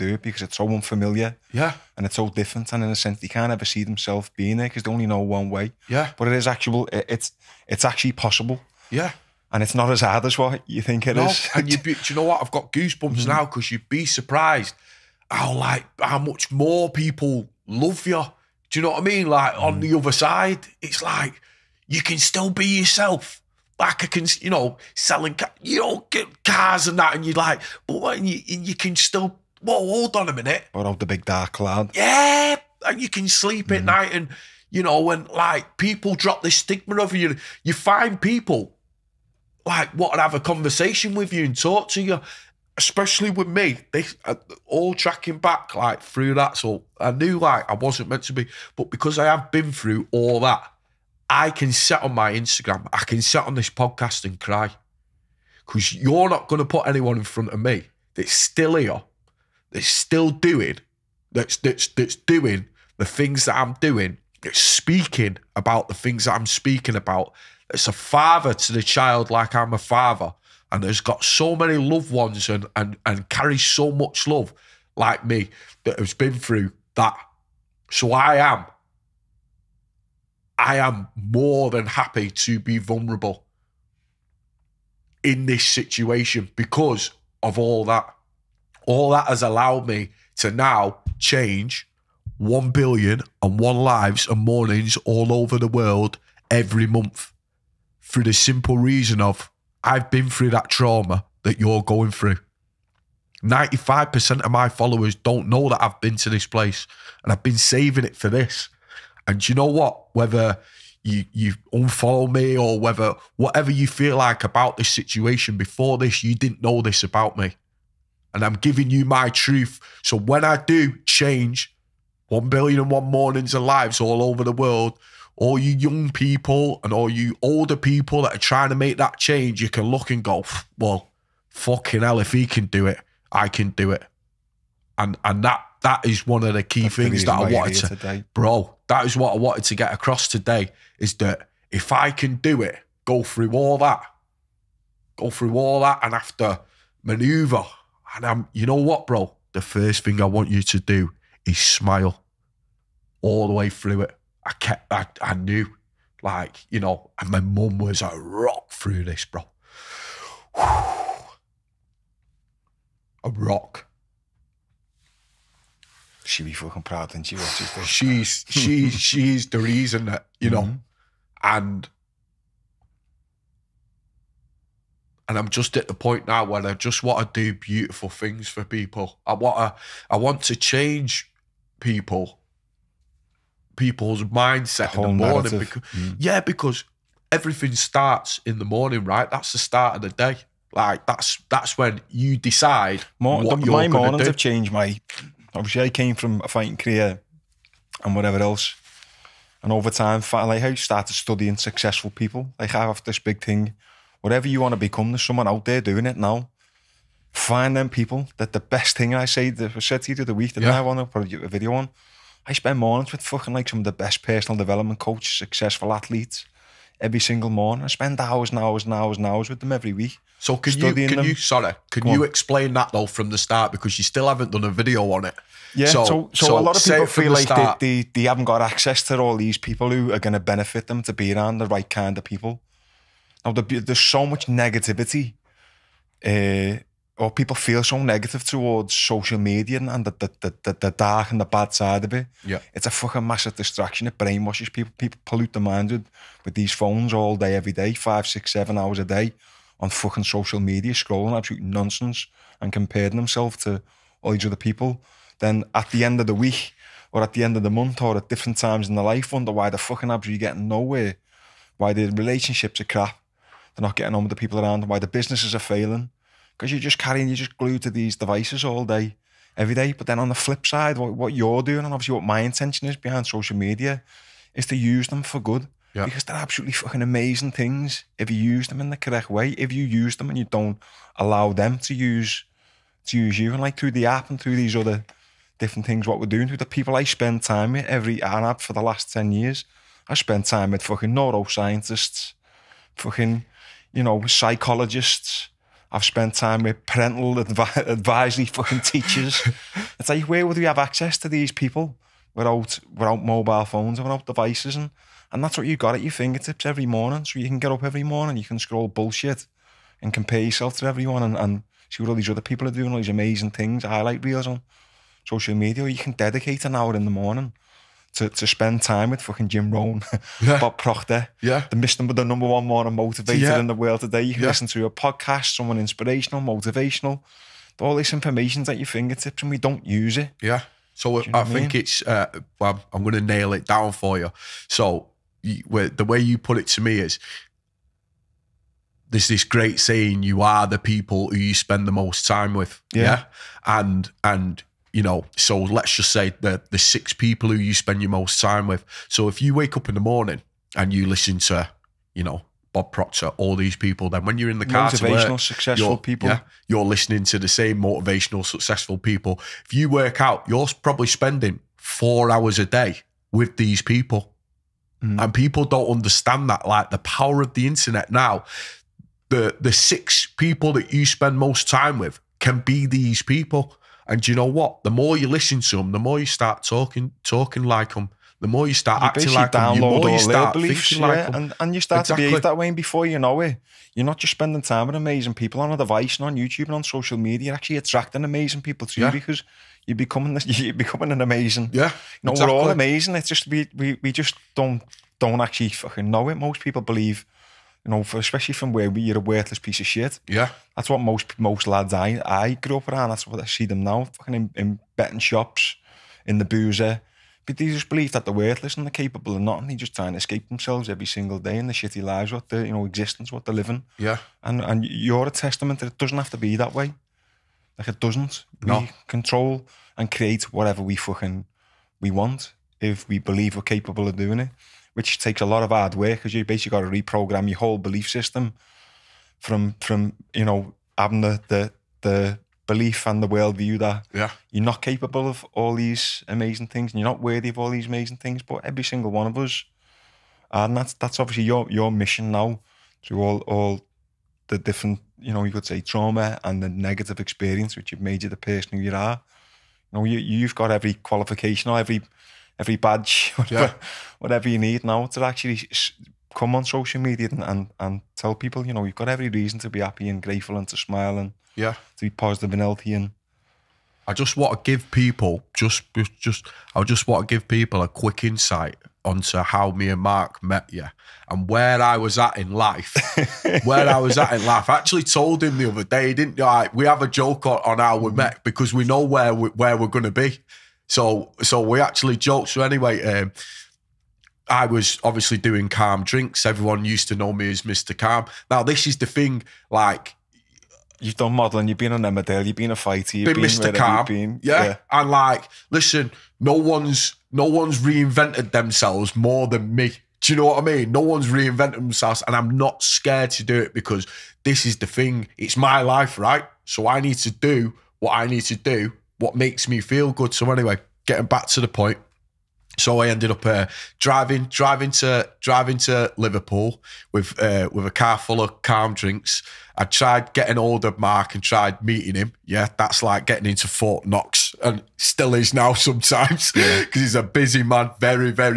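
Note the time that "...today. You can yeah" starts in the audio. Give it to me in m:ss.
5:24.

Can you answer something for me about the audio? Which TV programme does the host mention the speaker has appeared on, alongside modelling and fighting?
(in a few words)
Emmerdale.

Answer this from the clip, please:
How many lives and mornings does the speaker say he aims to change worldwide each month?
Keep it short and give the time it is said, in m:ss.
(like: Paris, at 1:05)
1 billion and one, at 1:32.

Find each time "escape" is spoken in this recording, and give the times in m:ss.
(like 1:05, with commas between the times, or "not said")
6:50.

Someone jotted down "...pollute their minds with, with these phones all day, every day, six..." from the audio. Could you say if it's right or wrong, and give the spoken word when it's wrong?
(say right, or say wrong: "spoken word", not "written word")
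wrong: "five", not "six".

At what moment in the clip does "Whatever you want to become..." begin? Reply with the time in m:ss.
3:24.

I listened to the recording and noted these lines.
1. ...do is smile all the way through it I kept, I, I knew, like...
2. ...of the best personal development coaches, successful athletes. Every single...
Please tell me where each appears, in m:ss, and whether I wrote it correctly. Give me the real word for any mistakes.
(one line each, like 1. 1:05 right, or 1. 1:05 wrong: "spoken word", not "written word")
1. 2:30 right
2. 3:33 right.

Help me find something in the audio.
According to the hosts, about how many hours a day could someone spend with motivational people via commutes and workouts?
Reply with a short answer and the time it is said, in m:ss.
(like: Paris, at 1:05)
four hours, at 6:01.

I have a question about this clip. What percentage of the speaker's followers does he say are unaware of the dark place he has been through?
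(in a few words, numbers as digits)
95%.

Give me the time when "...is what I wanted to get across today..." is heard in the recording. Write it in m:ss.
2:19.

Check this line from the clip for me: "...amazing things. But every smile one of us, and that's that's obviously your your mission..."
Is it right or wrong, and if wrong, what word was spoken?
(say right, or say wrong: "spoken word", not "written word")
wrong: "single", not "smile".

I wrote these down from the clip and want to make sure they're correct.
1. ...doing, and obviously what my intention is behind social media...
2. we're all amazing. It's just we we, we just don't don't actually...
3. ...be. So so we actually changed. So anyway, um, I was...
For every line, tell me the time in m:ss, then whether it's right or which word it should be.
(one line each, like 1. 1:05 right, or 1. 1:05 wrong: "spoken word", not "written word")
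1. 4:31 right
2. 6:32 right
3. 8:00 wrong: "joked", not "changed".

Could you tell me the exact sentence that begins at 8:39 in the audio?
I tried getting hold of Mark and tried meeting him.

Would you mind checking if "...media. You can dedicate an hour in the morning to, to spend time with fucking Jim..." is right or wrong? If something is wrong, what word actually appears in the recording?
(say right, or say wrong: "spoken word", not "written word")
right.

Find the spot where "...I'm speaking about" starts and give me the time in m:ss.
1:06.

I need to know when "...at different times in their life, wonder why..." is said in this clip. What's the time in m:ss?
4:18.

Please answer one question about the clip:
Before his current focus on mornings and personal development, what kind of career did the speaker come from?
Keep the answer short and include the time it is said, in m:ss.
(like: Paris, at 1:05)
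fighting career, at 3:16.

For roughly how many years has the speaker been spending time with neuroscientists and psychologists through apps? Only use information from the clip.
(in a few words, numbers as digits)
ten years.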